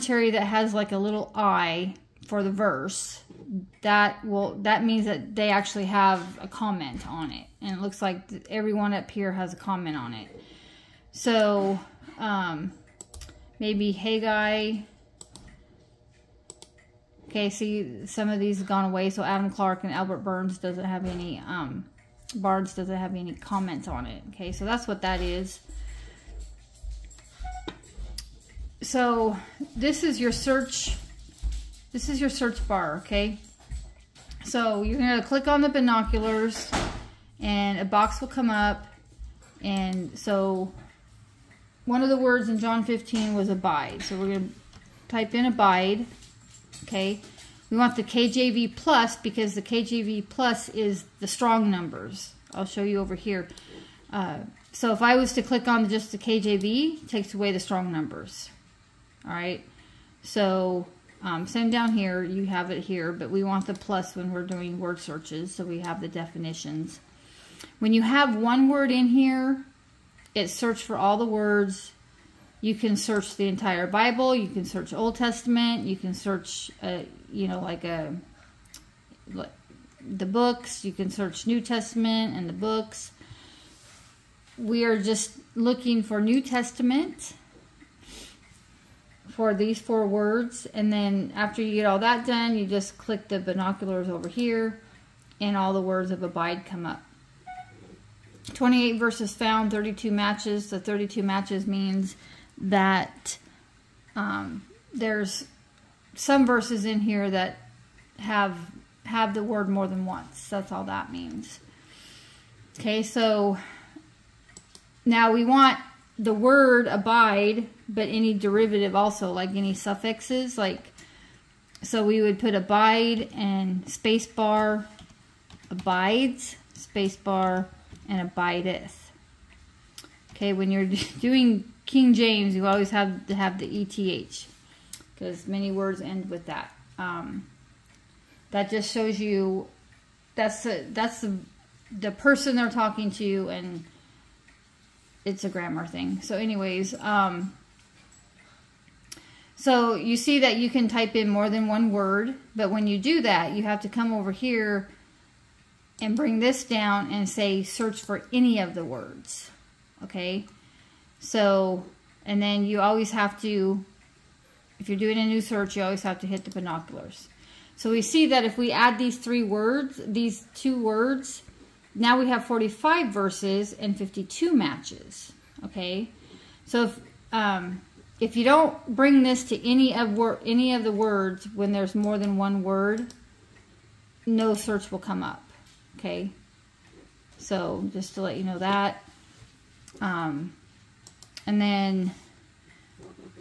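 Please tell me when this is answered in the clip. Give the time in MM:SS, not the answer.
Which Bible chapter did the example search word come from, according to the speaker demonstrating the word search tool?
00:42.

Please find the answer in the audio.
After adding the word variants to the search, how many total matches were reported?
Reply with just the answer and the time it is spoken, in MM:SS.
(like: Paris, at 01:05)
52, at 02:53.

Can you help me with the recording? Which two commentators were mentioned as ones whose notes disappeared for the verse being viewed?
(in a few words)
Adam Clarke and Albert Barnes.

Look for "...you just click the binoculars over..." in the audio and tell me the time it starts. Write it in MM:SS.
01:32.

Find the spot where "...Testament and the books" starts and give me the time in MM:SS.
01:21.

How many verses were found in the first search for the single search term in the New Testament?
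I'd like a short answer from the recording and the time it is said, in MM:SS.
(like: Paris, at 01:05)
28, at 01:38.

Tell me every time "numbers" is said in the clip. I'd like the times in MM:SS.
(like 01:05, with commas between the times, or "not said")
00:51, 00:57.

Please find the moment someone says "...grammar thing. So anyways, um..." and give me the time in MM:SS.
02:25.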